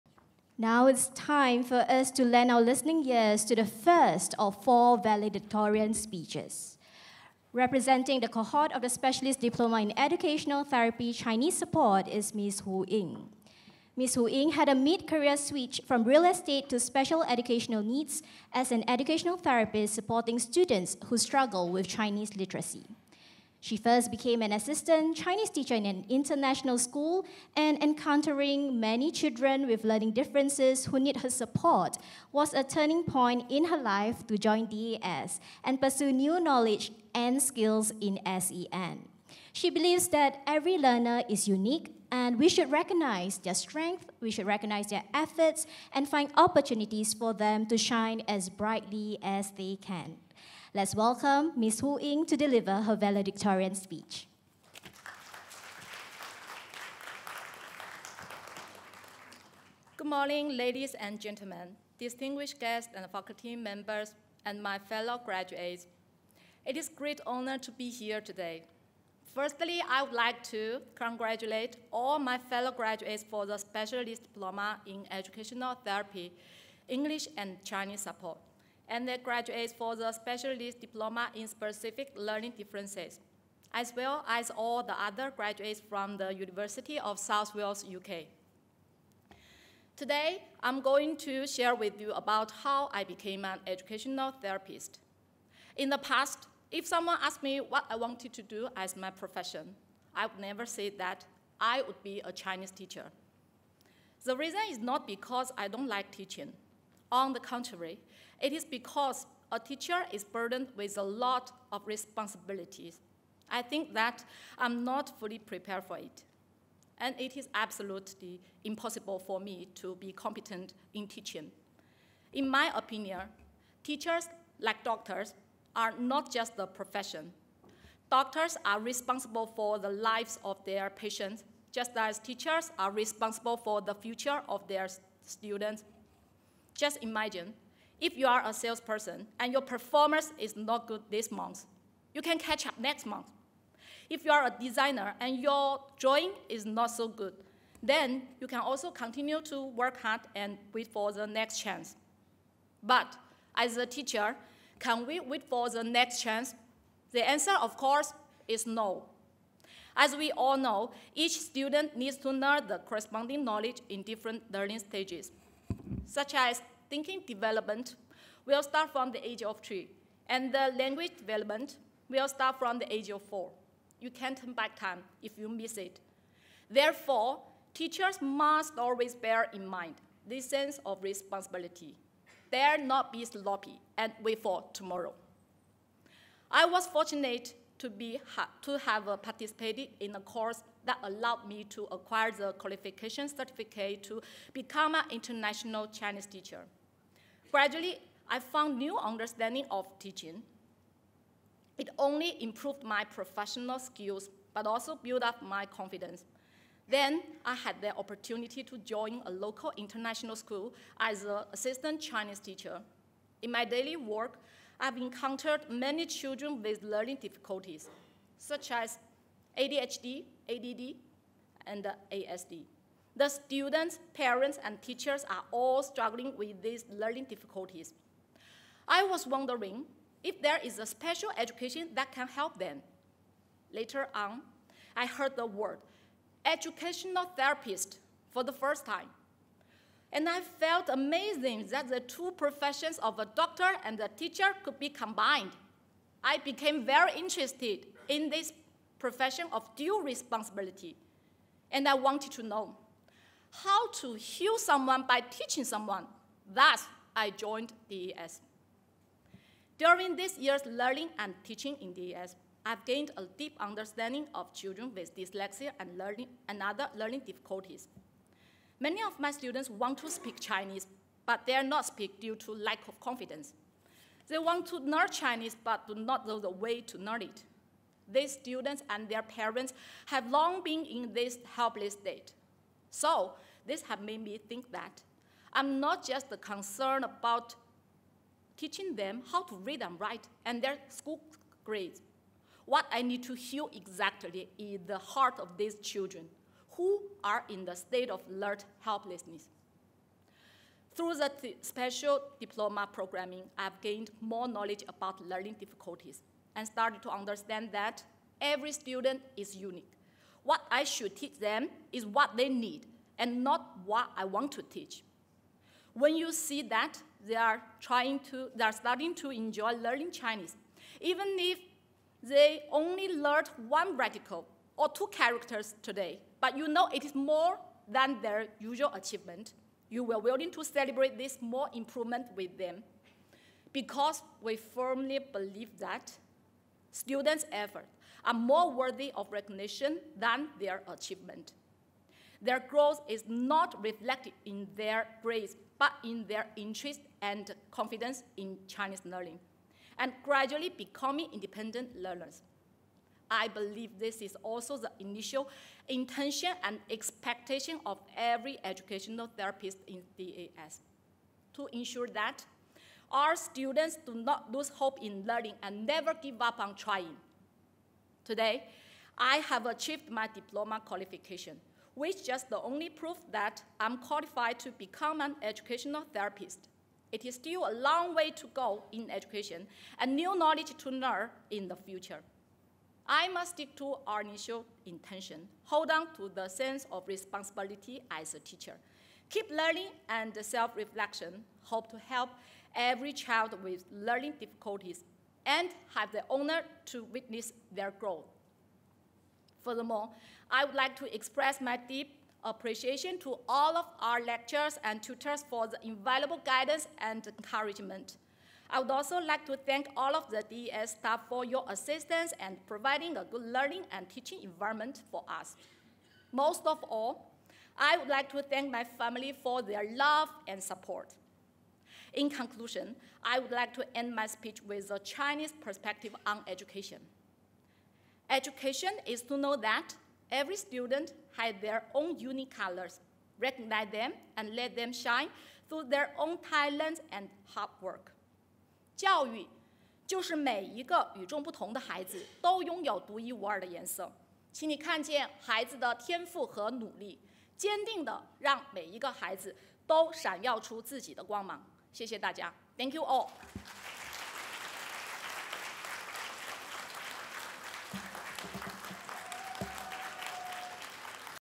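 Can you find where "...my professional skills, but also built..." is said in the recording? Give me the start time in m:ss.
3:22.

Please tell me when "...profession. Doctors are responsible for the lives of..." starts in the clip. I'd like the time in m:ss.
2:06.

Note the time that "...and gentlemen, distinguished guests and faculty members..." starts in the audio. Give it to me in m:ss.
1:00.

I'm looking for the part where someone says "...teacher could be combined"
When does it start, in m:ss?
4:04.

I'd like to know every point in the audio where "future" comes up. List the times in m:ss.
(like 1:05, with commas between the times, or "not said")
2:13, 6:21.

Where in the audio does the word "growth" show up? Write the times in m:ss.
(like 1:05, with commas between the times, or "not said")
5:42, 6:37.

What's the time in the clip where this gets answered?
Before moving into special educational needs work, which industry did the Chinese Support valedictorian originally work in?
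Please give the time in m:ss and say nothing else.
0:16.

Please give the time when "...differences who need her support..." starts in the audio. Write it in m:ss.
0:30.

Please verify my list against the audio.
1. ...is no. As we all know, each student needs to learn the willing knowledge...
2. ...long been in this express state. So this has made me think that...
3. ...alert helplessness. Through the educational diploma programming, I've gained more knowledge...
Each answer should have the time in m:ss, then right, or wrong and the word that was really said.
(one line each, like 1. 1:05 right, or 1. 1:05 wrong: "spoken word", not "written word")
1. 2:38 wrong: "corresponding", not "willing"
2. 4:40 wrong: "helpless", not "express"
3. 4:58 wrong: "special", not "educational".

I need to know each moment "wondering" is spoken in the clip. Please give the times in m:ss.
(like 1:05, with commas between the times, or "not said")
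3:49.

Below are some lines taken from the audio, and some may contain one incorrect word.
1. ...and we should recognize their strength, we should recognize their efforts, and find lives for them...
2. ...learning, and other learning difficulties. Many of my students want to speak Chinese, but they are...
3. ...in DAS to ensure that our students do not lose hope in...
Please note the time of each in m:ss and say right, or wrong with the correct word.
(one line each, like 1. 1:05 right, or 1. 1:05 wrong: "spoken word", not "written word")
1. 0:42 wrong: "opportunities", not "lives"
2. 4:25 right
3. 5:59 right.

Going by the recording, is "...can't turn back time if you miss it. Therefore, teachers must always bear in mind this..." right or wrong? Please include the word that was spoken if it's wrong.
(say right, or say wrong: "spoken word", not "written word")
right.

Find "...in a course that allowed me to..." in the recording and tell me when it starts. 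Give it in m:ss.
3:09.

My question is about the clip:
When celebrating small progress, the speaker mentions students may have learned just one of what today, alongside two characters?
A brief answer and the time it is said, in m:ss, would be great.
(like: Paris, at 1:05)
Radical, at 5:23.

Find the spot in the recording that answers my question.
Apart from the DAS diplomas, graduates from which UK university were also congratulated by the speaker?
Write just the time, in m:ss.
1:26.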